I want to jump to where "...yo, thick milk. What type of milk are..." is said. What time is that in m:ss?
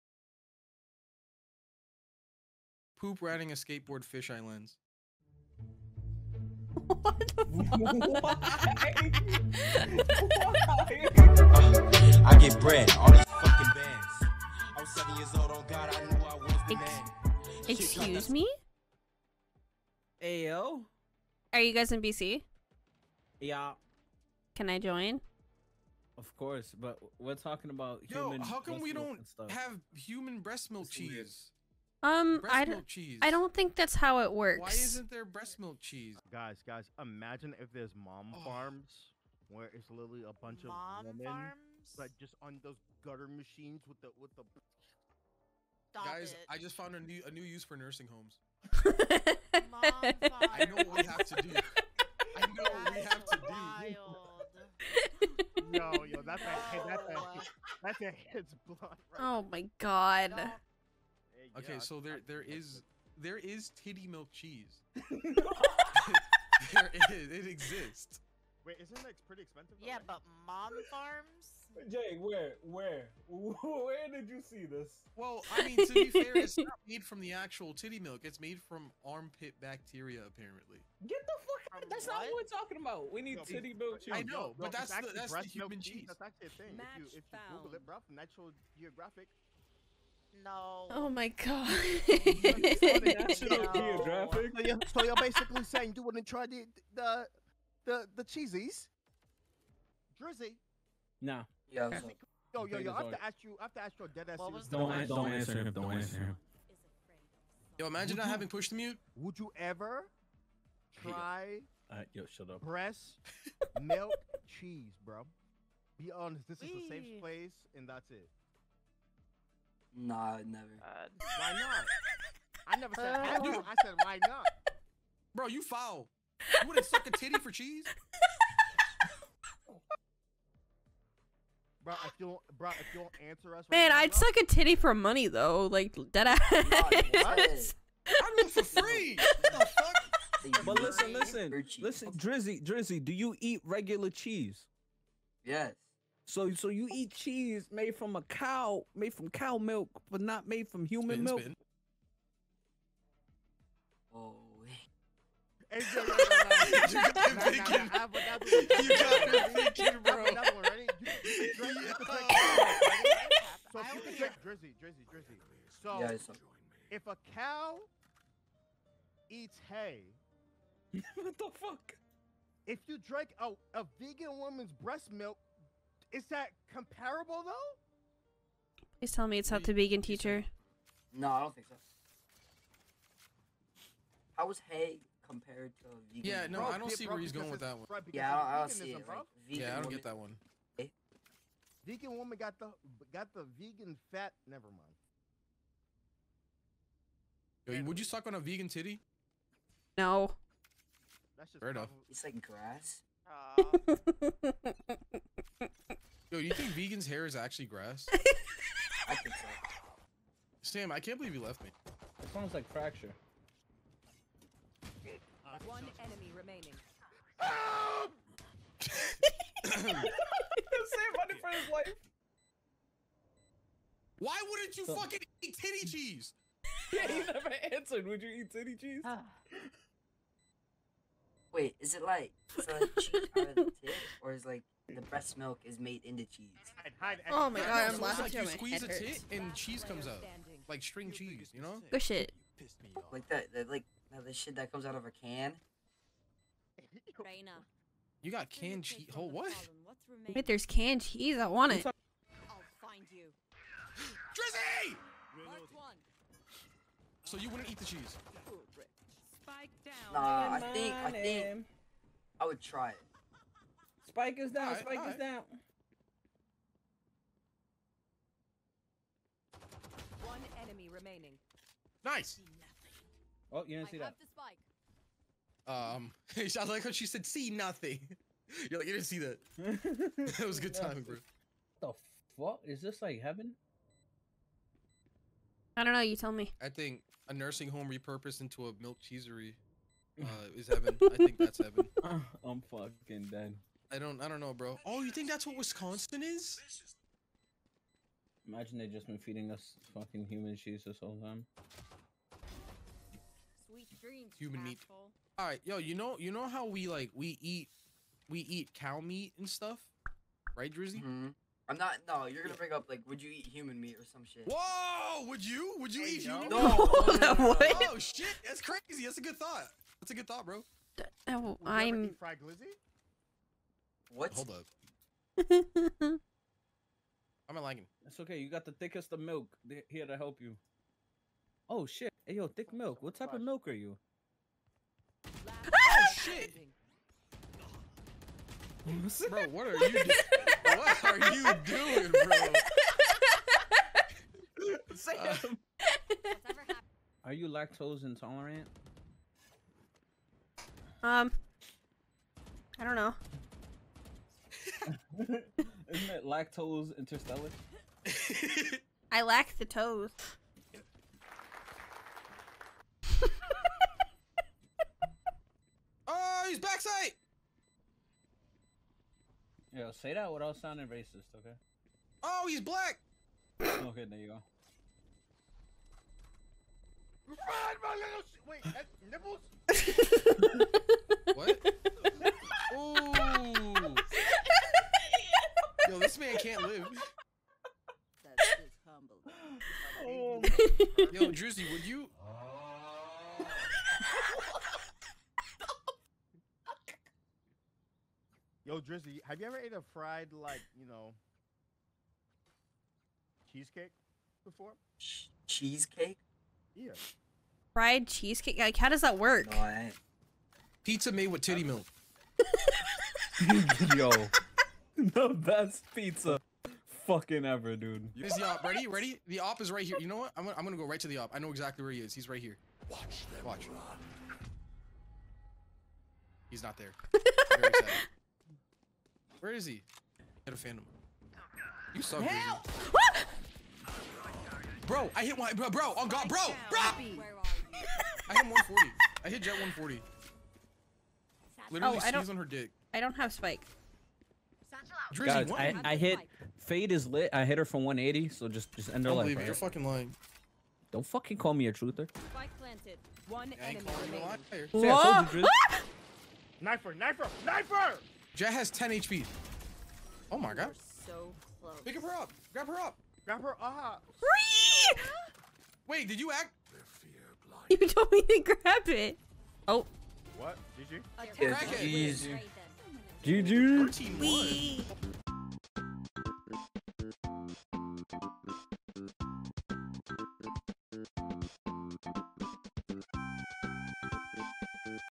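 5:32.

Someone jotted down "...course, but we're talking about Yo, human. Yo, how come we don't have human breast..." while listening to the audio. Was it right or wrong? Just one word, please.
right.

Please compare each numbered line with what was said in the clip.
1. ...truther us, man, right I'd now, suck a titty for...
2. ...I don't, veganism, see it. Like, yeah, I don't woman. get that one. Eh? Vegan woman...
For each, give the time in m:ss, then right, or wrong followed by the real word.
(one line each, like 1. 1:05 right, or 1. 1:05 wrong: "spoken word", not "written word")
1. 2:13 wrong: "answer", not "truther"
2. 3:08 right.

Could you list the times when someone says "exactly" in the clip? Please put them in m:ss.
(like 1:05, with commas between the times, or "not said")
7:01.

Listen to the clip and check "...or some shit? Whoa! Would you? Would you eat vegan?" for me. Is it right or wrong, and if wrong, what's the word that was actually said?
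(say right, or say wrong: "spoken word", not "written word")
wrong: "human", not "vegan".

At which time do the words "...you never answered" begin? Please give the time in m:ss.
3:47.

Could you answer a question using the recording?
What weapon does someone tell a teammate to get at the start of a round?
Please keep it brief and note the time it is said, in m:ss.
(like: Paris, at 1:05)
Phantom, at 7:10.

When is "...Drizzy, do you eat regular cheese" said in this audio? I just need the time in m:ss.
2:22.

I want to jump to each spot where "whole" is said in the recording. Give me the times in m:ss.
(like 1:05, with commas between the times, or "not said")
5:00.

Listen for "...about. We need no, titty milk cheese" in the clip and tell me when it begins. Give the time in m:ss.
1:22.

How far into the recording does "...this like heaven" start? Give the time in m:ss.
4:42.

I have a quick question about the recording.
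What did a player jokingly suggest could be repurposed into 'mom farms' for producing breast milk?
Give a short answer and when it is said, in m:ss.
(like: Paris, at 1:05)
Nursing homes, at 0:47.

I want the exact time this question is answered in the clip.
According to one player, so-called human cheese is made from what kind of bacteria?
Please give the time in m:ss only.
1:19.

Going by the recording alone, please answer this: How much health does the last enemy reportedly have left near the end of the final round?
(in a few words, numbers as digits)
10 HP.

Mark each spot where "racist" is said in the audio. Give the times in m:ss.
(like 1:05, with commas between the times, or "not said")
6:10.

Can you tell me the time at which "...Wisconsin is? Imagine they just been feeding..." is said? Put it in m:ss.
4:55.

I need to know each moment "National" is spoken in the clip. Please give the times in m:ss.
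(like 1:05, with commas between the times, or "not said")
1:32.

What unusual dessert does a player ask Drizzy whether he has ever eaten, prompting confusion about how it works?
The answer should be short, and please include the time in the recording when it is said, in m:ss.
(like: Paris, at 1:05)
Fried cheesecake, at 6:39.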